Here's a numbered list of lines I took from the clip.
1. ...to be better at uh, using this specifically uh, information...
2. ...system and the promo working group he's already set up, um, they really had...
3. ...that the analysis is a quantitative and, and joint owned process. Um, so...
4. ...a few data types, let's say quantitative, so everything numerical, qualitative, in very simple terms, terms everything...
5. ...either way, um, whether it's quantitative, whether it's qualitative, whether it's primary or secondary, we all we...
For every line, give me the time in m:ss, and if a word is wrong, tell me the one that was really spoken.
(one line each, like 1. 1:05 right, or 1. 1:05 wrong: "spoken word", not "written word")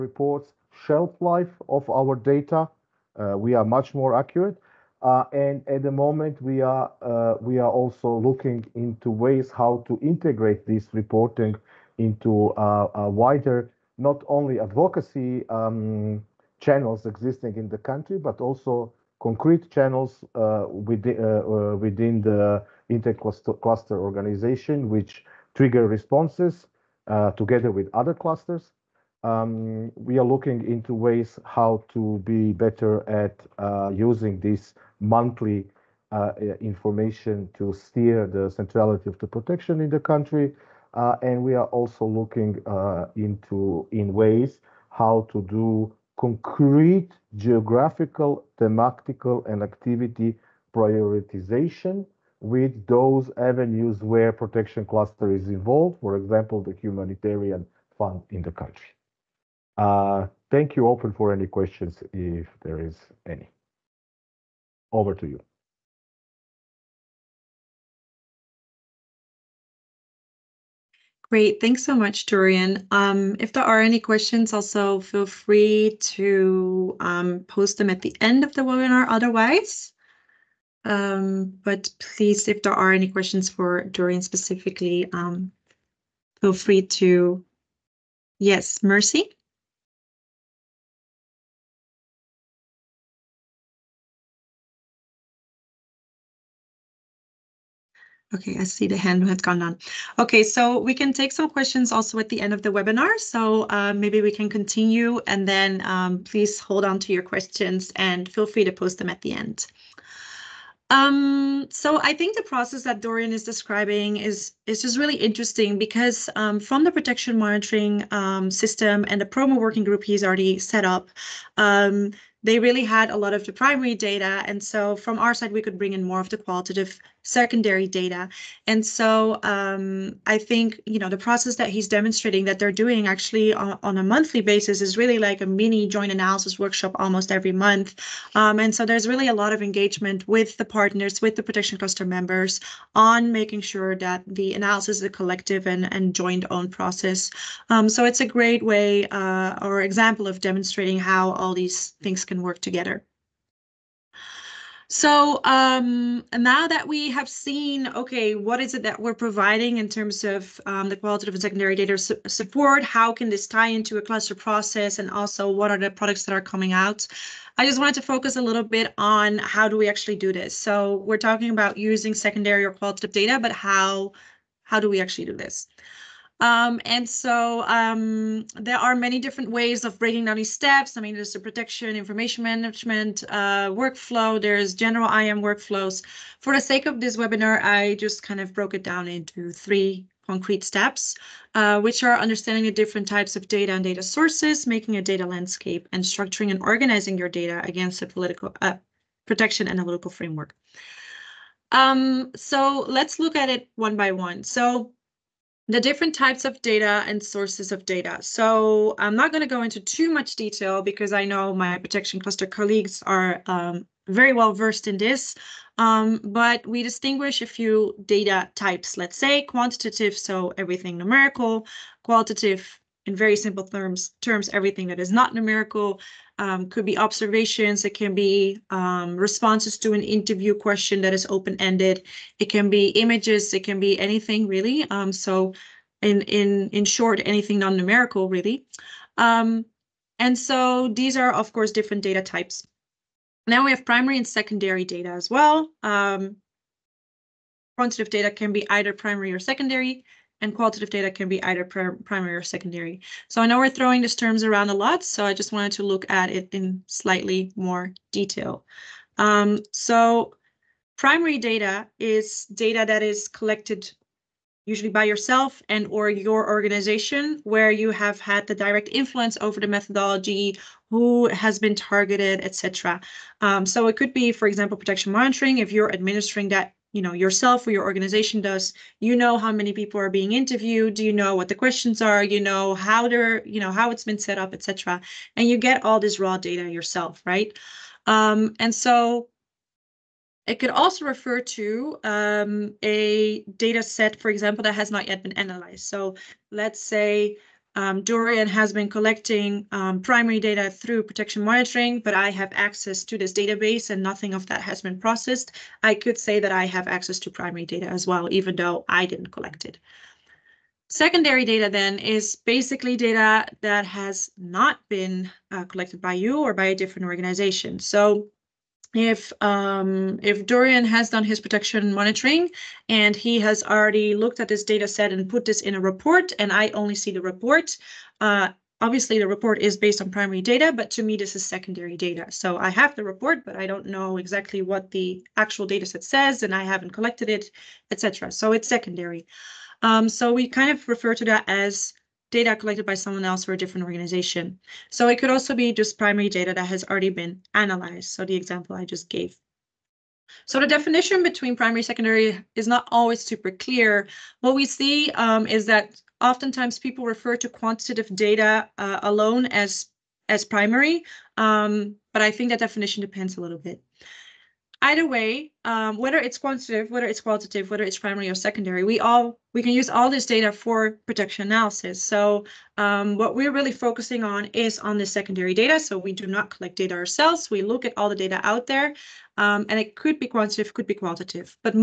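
1. 0:31 wrong: "monthly", not "specifically"
2. 1:58 right
3. 2:23 wrong: "collective", not "quantitative"
4. 3:37 right
5. 6:04 right.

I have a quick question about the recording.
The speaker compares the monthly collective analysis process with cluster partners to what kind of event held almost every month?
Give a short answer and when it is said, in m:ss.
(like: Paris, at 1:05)
mini joint analysis workshop, at 2:15.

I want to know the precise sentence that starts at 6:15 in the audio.
So we do not collect data ourselves.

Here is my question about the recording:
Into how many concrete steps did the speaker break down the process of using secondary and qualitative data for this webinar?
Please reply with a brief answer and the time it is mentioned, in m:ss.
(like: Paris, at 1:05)
3, at 3:09.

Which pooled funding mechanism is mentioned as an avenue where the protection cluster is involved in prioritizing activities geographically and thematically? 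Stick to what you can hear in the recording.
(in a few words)
humanitarian fund.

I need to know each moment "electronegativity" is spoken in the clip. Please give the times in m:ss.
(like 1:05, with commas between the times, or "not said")
not said.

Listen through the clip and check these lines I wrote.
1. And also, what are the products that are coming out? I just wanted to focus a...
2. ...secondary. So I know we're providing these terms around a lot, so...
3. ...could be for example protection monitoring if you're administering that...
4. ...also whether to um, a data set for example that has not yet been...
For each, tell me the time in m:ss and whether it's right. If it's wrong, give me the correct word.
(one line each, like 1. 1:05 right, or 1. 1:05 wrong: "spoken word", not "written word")
1. 2:44 right
2. 4:12 wrong: "throwing", not "providing"
3. 4:33 right
4. 4:50 wrong: "refer", not "whether".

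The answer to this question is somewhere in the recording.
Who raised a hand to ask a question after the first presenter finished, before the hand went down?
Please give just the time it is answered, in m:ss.
1:28.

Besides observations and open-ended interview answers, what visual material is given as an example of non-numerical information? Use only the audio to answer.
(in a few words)
images.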